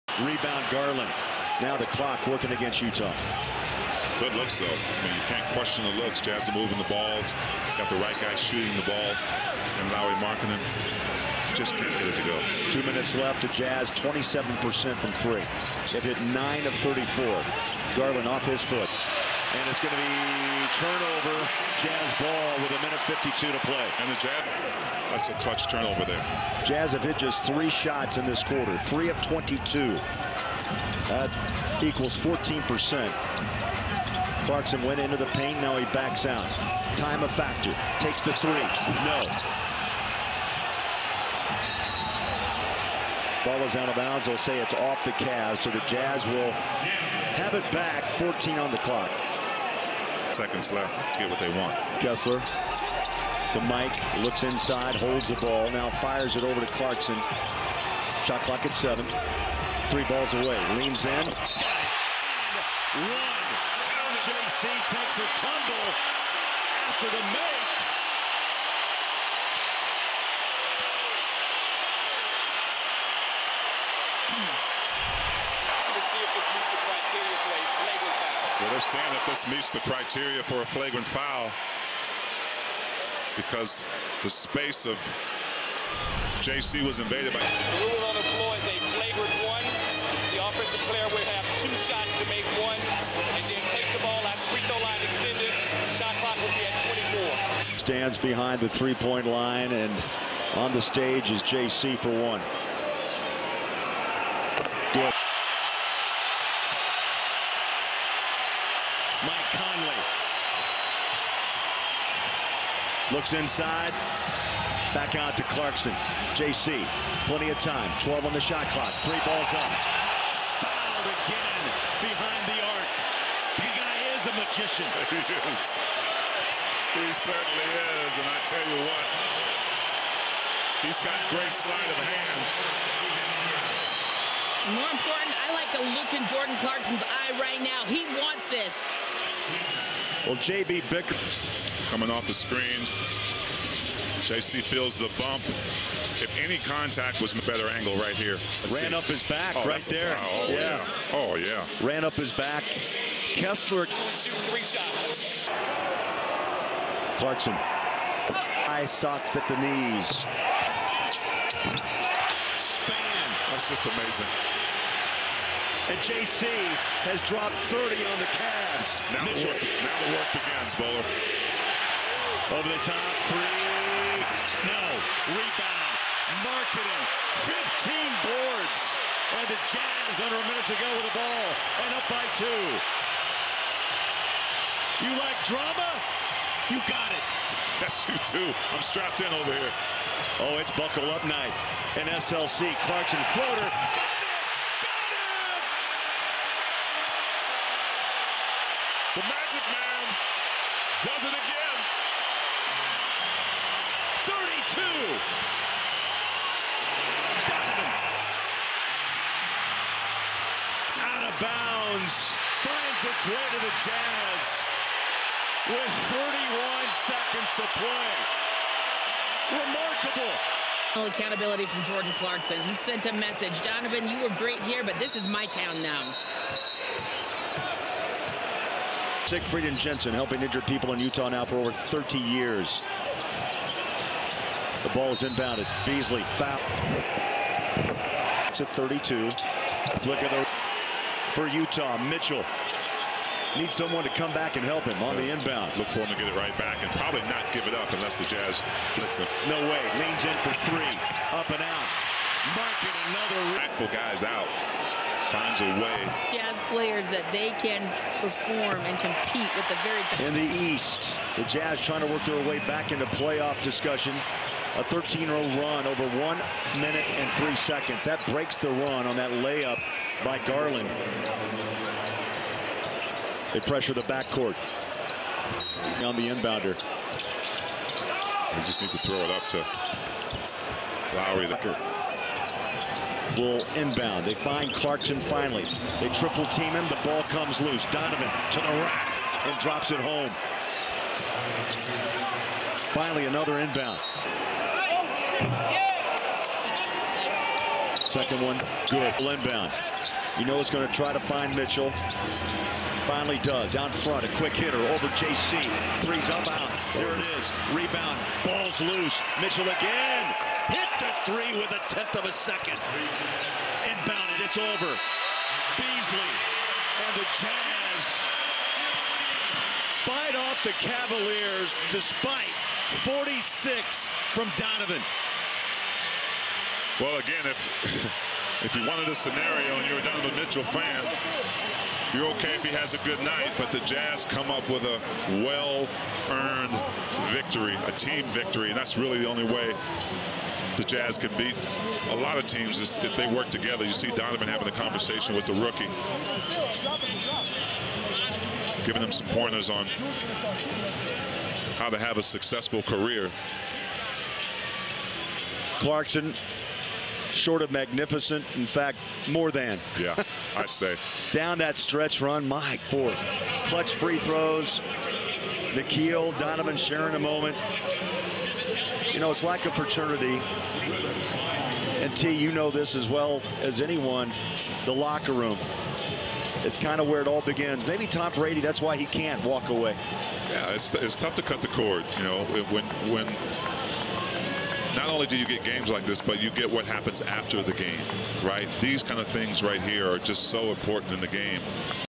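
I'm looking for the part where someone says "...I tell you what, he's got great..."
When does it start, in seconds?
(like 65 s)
128 s.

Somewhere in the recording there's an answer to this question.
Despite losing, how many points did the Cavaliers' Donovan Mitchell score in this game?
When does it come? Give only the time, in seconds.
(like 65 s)
323 s.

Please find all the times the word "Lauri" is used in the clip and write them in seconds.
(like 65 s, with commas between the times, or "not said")
9 s, 281 s.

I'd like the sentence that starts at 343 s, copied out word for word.
You see Donovan having a conversation with the rookie, giving them some pointers on how to have a successful career.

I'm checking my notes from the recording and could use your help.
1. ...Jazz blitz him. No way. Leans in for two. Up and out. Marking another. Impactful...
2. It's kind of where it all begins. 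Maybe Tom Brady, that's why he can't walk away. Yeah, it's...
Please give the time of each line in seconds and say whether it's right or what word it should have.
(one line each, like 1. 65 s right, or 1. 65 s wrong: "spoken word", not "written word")
1. 248 s wrong: "three", not "two"
2. 376 s right.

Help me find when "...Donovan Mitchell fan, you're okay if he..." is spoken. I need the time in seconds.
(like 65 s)
330 s.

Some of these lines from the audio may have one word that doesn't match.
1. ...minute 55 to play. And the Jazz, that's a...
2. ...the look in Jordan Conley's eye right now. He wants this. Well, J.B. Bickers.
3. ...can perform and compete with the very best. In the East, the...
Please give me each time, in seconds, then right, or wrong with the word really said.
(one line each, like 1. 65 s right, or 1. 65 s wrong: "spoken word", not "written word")
1. 22 s wrong: "52", not "55"
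2. 135 s wrong: "Clarkson", not "Conley"
3. 257 s right.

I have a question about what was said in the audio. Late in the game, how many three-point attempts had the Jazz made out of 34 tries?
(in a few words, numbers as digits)
9.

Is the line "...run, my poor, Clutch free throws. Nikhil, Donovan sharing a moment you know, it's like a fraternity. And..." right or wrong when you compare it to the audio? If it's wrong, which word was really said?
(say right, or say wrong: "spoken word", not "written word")
right.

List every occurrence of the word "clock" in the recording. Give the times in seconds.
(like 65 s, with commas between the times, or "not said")
1 s, 48 s, 58 s, 96 s, 118 s.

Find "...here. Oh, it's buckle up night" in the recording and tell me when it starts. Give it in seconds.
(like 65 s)
189 s.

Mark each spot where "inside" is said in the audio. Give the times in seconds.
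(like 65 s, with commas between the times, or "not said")
54 s, 113 s.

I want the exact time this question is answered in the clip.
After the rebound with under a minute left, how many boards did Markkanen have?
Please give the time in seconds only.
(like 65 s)
177 s.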